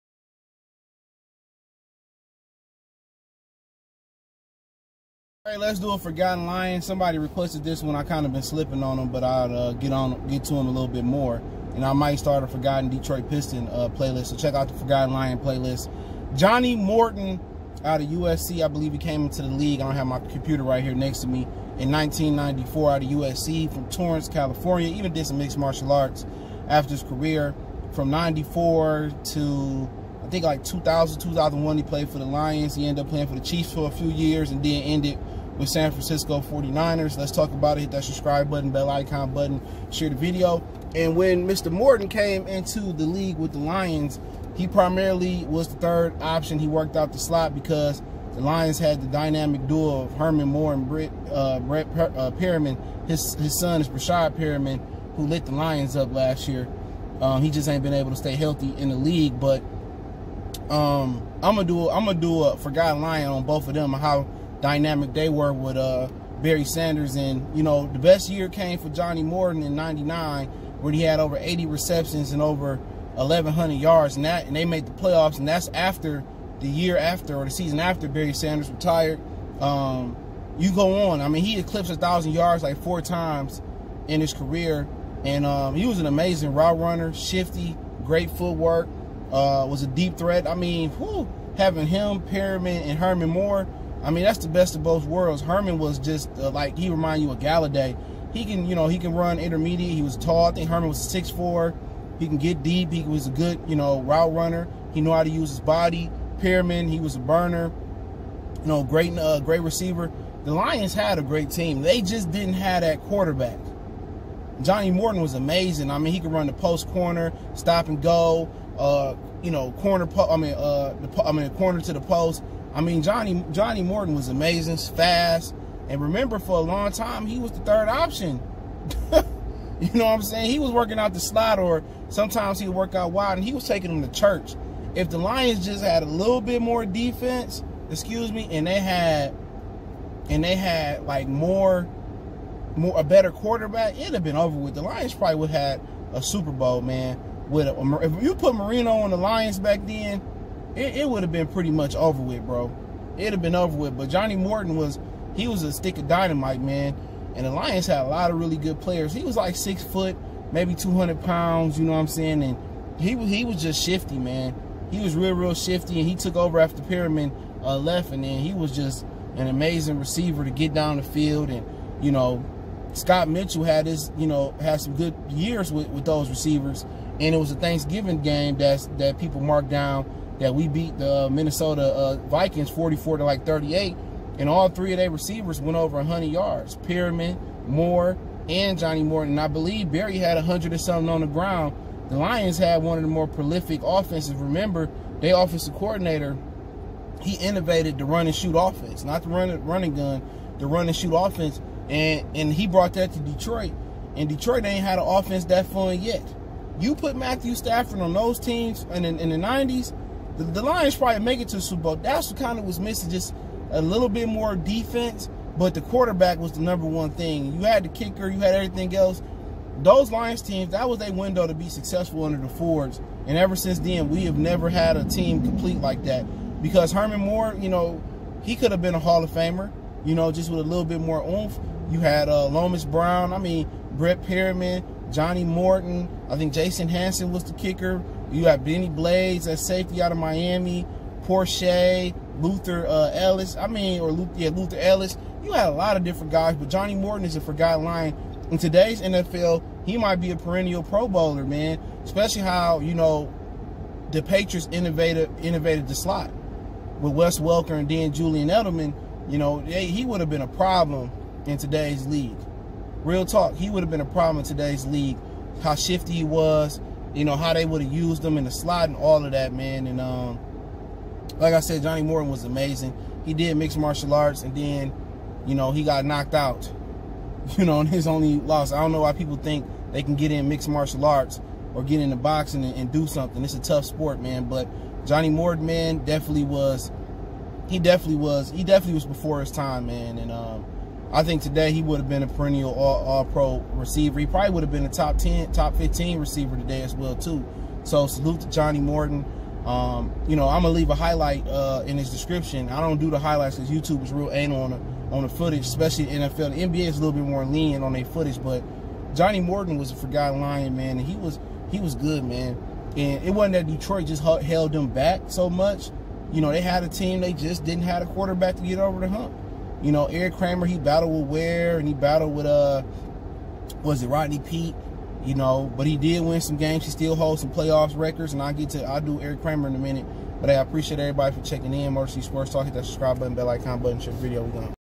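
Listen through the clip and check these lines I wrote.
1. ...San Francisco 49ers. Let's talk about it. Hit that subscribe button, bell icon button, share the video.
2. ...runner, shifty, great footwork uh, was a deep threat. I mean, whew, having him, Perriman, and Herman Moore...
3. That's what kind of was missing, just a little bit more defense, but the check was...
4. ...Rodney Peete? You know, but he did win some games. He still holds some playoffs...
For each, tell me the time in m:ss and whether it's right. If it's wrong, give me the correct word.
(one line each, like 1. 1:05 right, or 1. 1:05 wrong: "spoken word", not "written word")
1. 0:35 right
2. 1:26 right
3. 3:31 wrong: "quarterback", not "check"
4. 5:24 right.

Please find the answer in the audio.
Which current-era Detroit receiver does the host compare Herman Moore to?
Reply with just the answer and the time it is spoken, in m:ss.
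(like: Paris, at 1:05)
Golladay, at 1:37.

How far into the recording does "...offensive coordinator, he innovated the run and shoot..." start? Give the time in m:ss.
3:15.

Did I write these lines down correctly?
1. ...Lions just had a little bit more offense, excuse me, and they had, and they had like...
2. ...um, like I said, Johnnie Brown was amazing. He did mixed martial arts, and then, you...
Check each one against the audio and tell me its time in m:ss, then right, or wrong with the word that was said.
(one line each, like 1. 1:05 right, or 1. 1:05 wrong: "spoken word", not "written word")
1. 2:15 wrong: "defense", not "offense"
2. 4:30 wrong: "Morton", not "Brown".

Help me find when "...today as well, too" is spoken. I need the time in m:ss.
4:56.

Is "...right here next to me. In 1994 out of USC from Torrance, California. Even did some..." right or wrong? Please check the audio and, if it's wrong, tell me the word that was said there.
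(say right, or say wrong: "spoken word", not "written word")
right.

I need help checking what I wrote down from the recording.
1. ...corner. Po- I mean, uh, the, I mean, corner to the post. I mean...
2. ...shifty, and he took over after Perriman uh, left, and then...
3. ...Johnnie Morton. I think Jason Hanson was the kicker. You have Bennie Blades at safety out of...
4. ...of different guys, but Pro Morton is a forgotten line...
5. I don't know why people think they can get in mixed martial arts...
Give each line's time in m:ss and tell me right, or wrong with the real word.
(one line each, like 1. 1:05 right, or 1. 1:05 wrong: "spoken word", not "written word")
1. 1:59 right
2. 2:45 right
3. 3:55 right
4. 4:05 wrong: "Johnnie", not "Pro"
5. 4:38 right.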